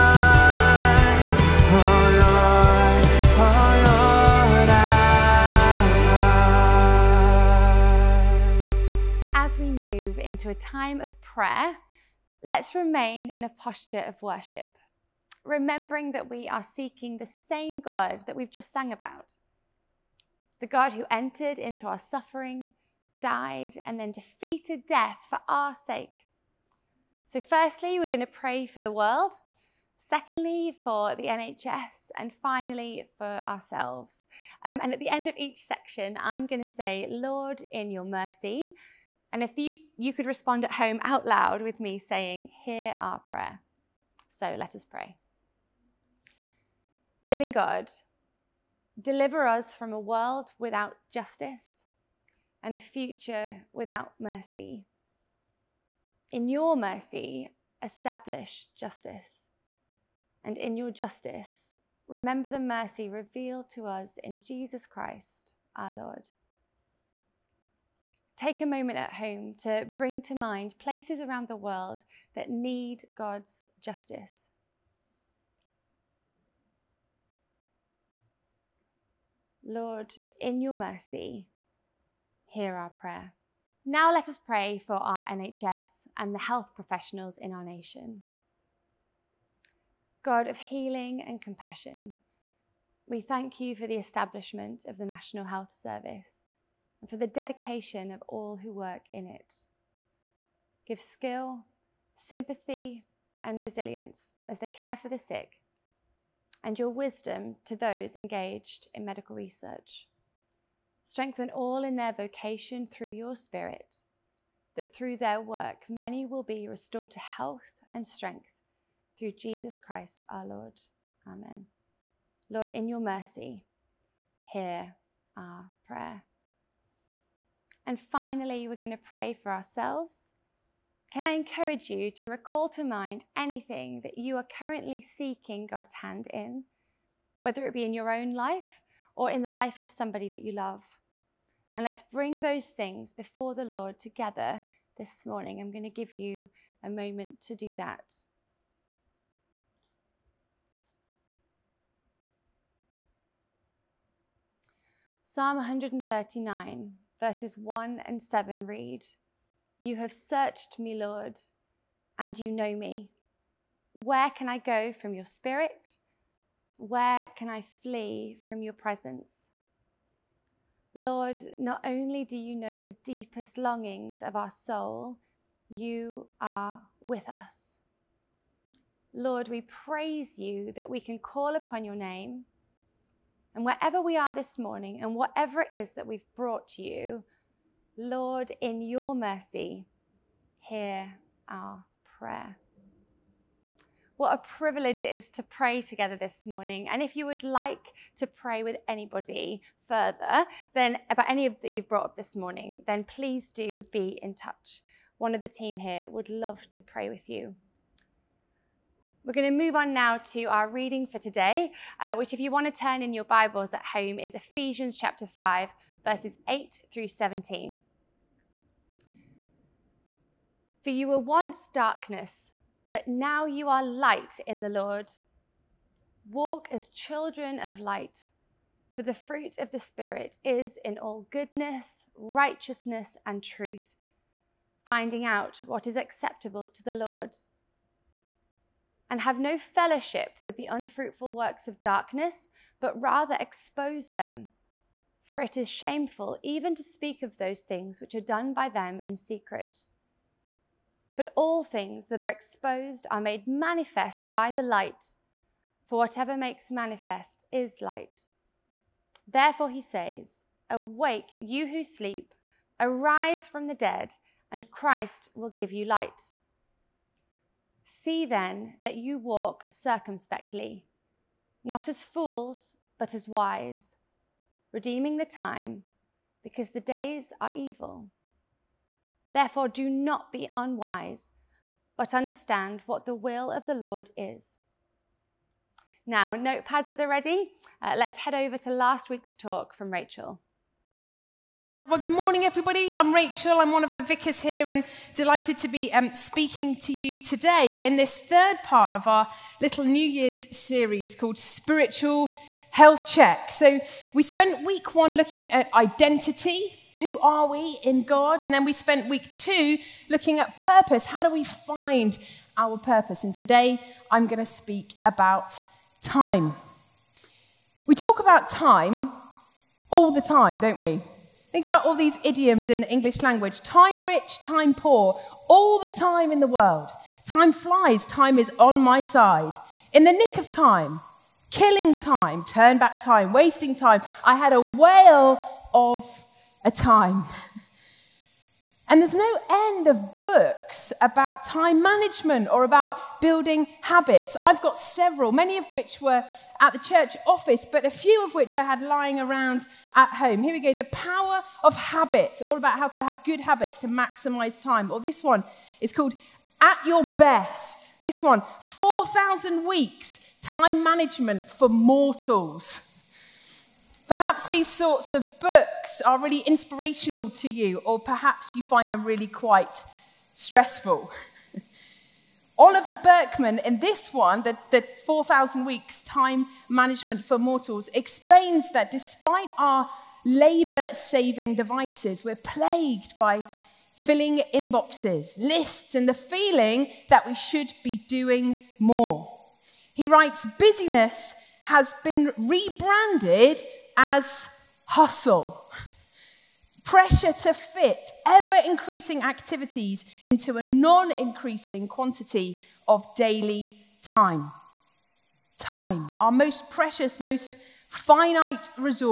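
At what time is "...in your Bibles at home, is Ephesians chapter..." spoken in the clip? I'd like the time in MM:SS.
03:33.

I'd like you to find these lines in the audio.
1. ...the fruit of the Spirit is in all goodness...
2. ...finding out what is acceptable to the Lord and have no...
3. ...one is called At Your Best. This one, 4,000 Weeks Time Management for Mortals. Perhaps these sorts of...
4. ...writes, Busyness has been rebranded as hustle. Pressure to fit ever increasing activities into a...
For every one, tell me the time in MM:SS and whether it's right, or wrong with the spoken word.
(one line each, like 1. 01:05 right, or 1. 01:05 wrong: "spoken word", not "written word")
1. 03:49 right
2. 03:54 right
3. 05:55 right
4. 06:30 right.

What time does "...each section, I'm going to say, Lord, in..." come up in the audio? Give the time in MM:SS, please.
00:35.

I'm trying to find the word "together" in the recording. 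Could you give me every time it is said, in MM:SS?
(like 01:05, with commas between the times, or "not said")
02:23, 03:15.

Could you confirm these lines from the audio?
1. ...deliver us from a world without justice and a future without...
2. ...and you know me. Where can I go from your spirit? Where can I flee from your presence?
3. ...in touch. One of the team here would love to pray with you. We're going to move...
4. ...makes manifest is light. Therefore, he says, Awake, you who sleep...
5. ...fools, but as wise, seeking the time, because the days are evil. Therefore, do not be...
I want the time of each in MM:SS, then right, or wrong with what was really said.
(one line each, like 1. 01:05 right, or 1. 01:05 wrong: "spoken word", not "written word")
1. 00:48 right
2. 02:42 right
3. 03:24 right
4. 04:16 right
5. 04:32 wrong: "redeeming", not "seeking".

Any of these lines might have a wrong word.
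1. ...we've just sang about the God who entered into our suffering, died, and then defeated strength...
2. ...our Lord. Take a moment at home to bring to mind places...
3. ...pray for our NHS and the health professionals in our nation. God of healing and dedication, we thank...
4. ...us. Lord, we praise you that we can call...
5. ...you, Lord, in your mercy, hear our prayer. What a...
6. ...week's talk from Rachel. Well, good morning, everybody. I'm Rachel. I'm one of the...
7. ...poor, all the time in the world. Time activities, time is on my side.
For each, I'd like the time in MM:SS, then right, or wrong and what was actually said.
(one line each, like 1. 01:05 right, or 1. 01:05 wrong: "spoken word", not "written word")
1. 00:18 wrong: "death", not "strength"
2. 01:05 right
3. 01:24 wrong: "compassion", not "dedication"
4. 02:57 right
5. 03:06 right
6. 04:49 right
7. 05:24 wrong: "flies", not "activities".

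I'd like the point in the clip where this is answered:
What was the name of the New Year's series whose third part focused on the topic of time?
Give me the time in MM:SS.
05:01.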